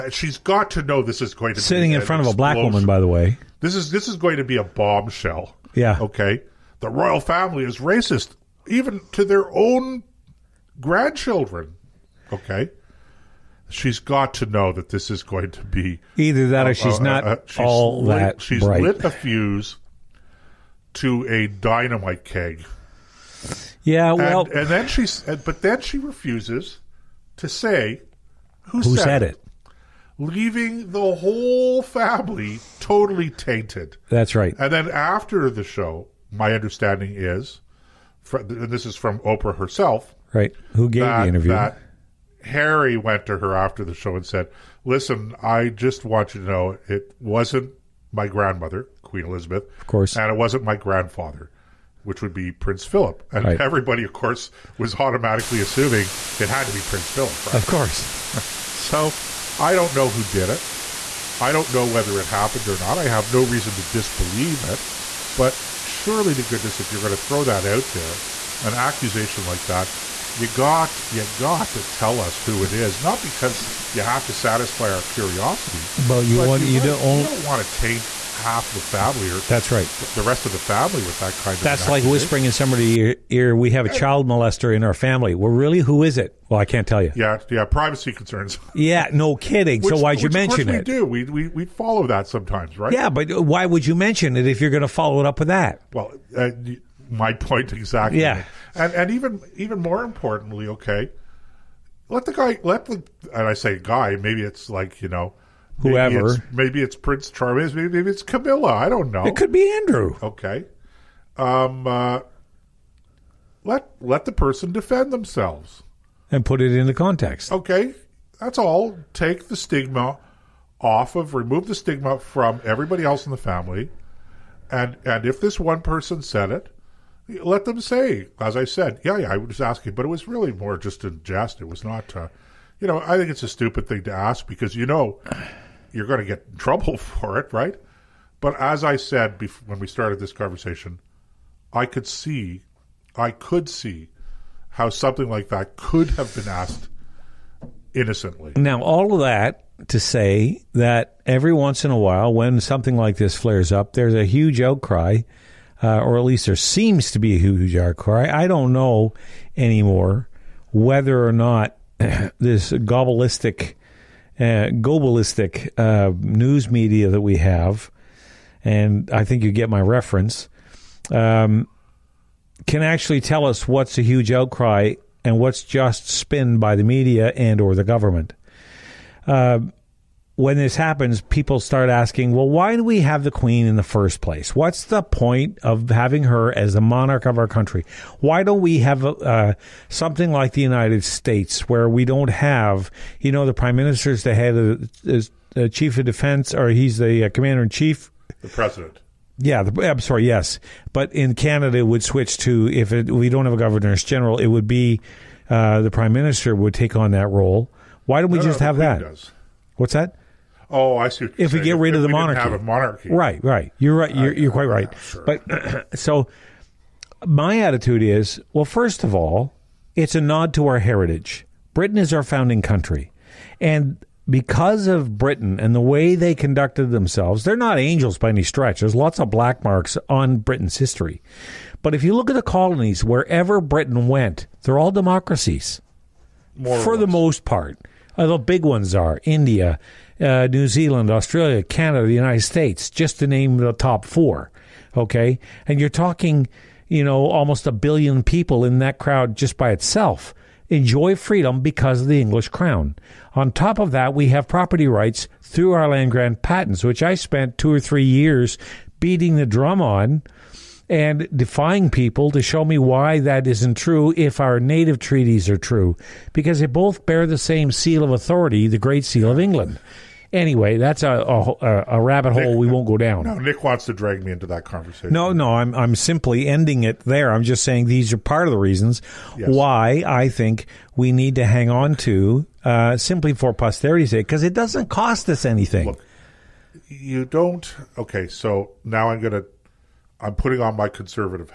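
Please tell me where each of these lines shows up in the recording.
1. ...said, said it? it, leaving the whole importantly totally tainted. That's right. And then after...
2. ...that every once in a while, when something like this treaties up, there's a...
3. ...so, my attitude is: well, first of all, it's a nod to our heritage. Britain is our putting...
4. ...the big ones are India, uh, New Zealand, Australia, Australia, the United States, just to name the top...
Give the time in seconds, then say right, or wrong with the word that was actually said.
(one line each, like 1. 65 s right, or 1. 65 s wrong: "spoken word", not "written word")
1. 28 s wrong: "family", not "importantly"
2. 150 s wrong: "flares", not "treaties"
3. 215 s wrong: "founding", not "putting"
4. 238 s wrong: "Canada", not "Australia".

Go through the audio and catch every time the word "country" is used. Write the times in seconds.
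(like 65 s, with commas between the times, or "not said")
187 s, 222 s.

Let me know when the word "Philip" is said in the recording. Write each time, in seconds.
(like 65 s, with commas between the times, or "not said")
52 s, 57 s.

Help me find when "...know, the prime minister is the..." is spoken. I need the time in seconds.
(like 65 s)
193 s.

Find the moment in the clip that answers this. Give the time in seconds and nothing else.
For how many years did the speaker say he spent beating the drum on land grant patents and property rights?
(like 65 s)
257 s.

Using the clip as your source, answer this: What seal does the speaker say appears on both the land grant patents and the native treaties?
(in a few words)
The Great Seal of England.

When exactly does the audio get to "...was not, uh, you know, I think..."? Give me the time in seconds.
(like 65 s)
131 s.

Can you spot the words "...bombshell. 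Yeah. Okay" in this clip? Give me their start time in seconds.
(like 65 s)
4 s.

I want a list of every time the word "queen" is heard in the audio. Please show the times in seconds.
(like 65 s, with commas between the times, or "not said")
49 s, 183 s.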